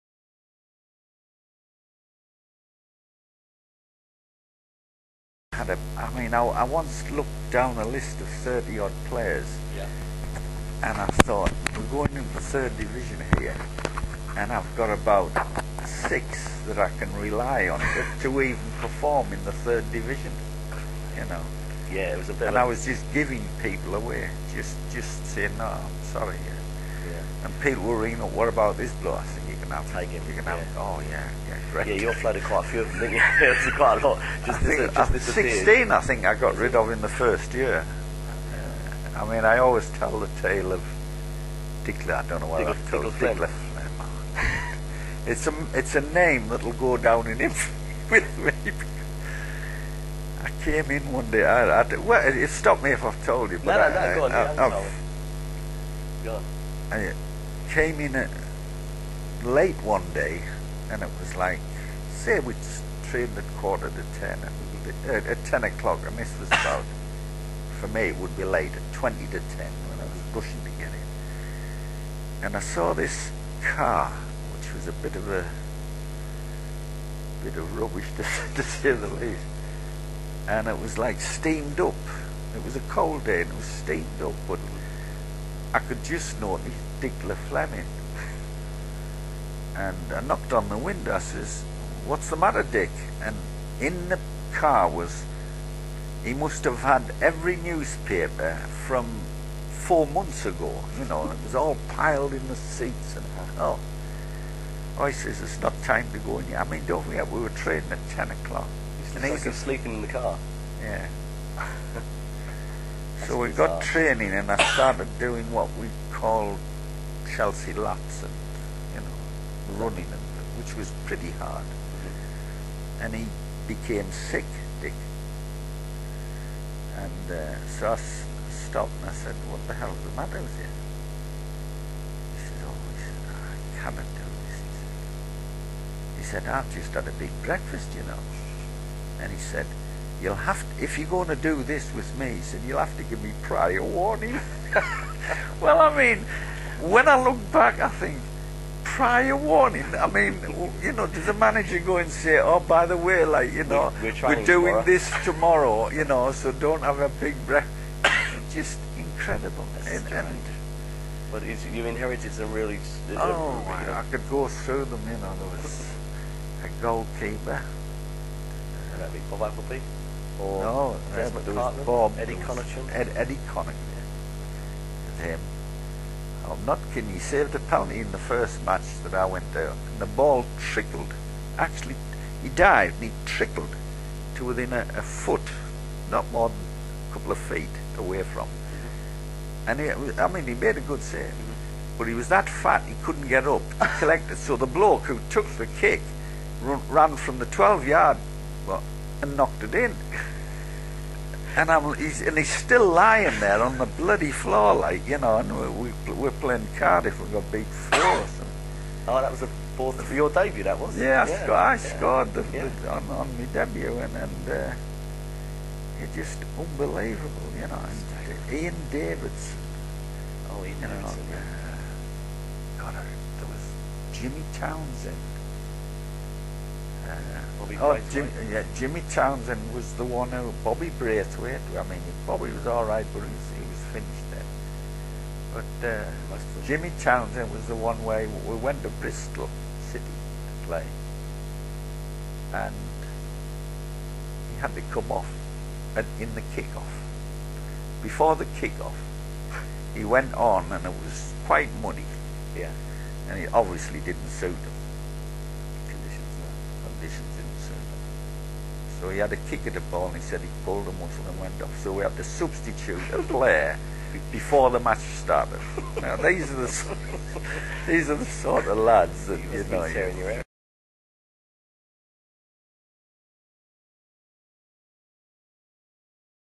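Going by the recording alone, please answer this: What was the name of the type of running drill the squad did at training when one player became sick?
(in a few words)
Chelsea laps.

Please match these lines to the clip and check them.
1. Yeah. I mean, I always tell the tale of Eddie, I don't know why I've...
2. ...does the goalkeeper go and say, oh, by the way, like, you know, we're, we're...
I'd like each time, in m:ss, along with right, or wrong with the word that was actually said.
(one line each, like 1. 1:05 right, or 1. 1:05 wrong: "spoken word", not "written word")
1. 0:38 wrong: "Dickler", not "Eddie"
2. 2:31 wrong: "manager", not "goalkeeper".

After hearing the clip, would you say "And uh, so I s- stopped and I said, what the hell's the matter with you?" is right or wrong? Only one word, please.
right.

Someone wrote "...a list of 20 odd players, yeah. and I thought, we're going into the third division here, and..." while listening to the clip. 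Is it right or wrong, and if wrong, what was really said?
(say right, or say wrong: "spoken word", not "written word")
wrong: "30", not "20".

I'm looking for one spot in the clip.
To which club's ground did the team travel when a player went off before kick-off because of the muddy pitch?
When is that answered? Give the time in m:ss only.
3:58.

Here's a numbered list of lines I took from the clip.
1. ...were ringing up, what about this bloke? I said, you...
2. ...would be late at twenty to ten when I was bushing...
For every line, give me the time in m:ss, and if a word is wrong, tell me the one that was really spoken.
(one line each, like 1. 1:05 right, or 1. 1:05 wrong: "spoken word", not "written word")
1. 0:27 right
2. 1:08 right.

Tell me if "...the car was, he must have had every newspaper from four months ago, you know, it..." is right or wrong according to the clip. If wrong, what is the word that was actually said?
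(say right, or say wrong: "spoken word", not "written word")
right.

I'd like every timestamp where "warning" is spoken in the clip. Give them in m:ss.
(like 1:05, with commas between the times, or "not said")
2:23, 2:29.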